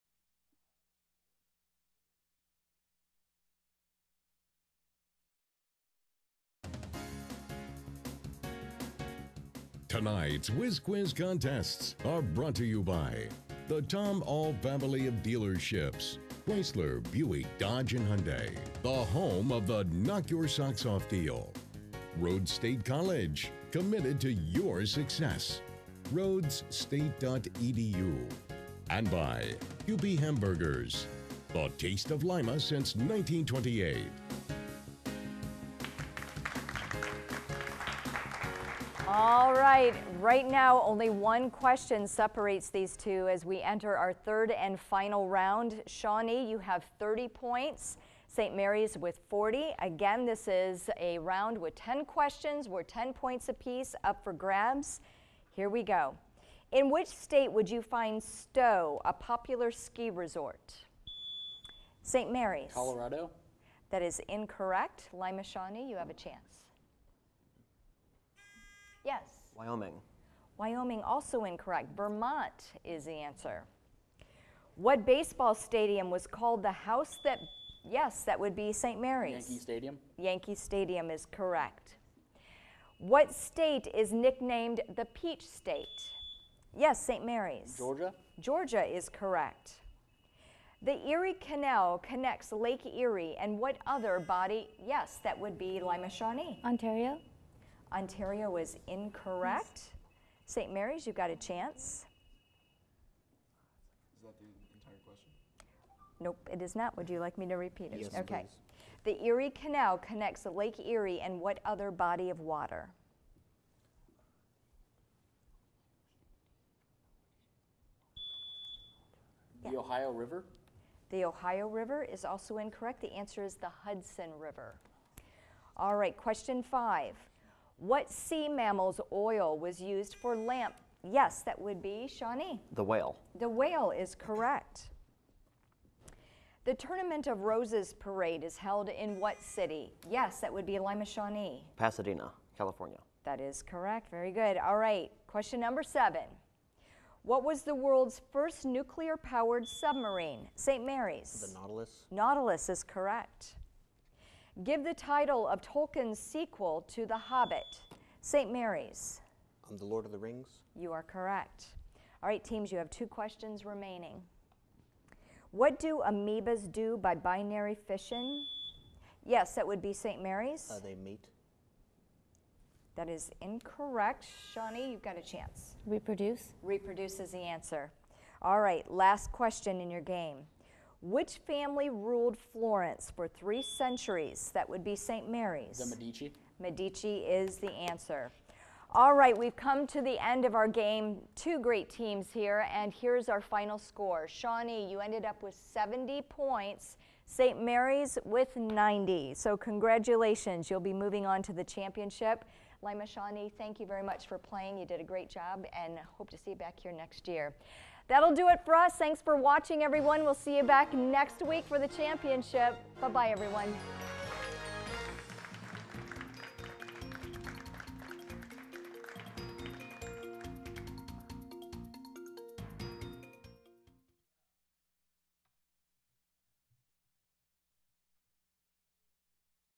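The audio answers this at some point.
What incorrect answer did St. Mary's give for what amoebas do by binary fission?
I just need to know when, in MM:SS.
02:50.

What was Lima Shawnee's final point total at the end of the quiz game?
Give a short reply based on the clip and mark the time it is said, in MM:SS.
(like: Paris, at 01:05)
70, at 03:15.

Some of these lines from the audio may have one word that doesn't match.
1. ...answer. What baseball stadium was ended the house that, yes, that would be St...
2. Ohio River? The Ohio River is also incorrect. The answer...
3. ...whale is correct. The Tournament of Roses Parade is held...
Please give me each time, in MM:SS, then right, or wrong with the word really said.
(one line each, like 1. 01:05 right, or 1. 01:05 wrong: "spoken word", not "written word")
1. 01:13 wrong: "called", not "ended"
2. 01:59 right
3. 02:13 right.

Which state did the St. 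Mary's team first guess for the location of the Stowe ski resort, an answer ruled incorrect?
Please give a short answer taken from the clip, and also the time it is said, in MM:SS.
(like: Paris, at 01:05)
Colorado, at 01:02.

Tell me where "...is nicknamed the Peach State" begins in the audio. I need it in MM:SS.
01:23.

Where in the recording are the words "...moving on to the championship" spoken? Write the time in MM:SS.
03:20.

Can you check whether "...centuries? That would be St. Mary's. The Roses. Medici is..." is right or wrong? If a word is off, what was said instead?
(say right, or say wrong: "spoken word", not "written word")
wrong: "Medici", not "Roses".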